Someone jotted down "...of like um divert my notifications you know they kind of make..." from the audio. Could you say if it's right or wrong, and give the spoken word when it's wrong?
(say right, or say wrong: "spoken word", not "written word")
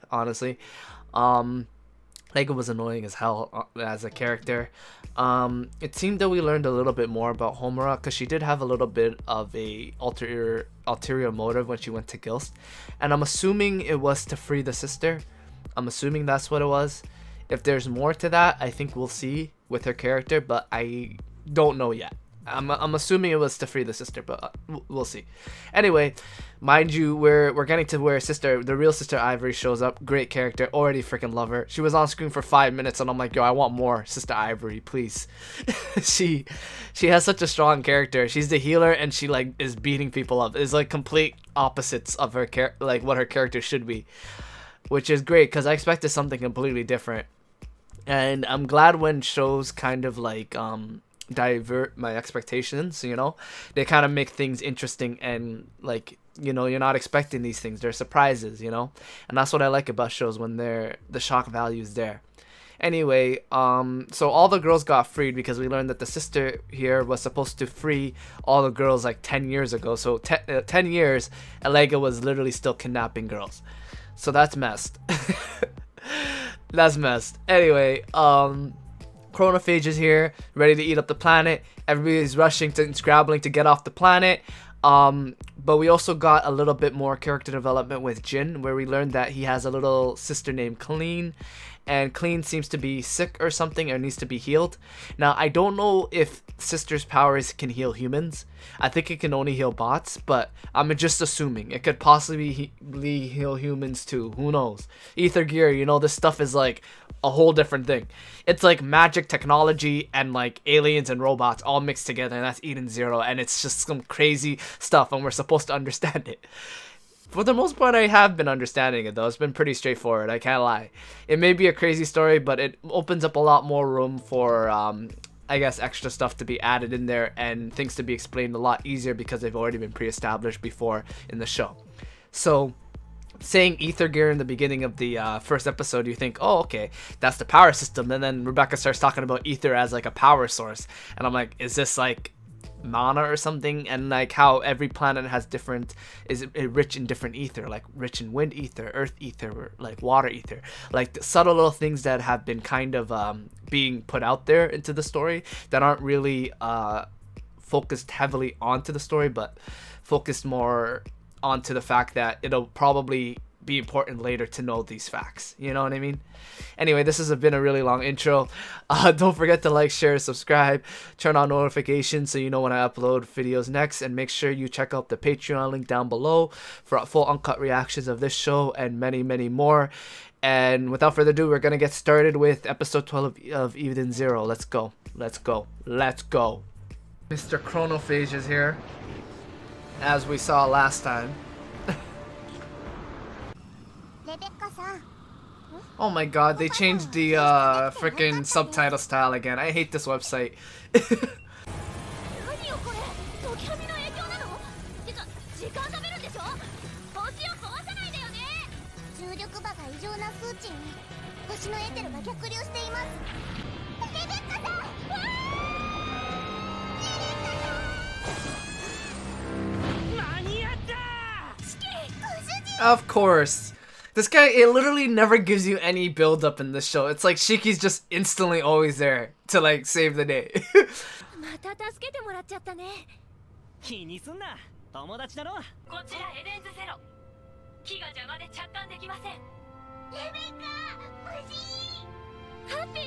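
wrong: "expectations", not "notifications".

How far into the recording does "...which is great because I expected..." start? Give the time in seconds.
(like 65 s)
44 s.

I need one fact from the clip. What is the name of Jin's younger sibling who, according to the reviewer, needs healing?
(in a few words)
Colleen.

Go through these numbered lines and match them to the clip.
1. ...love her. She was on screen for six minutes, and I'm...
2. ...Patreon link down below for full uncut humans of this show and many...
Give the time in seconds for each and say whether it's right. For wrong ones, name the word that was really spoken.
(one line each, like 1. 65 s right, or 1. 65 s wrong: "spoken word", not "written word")
1. 31 s wrong: "five", not "six"
2. 175 s wrong: "reactions", not "humans".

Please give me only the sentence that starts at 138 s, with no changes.
And then Rebecca starts talking about ether as like a power source.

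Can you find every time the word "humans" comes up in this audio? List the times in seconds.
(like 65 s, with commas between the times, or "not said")
97 s, 103 s.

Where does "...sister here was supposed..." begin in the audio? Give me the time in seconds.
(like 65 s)
66 s.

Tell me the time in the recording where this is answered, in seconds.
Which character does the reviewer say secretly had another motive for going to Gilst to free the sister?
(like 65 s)
7 s.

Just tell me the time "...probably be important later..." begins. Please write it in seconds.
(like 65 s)
162 s.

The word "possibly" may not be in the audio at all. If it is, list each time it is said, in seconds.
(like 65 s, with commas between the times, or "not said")
101 s.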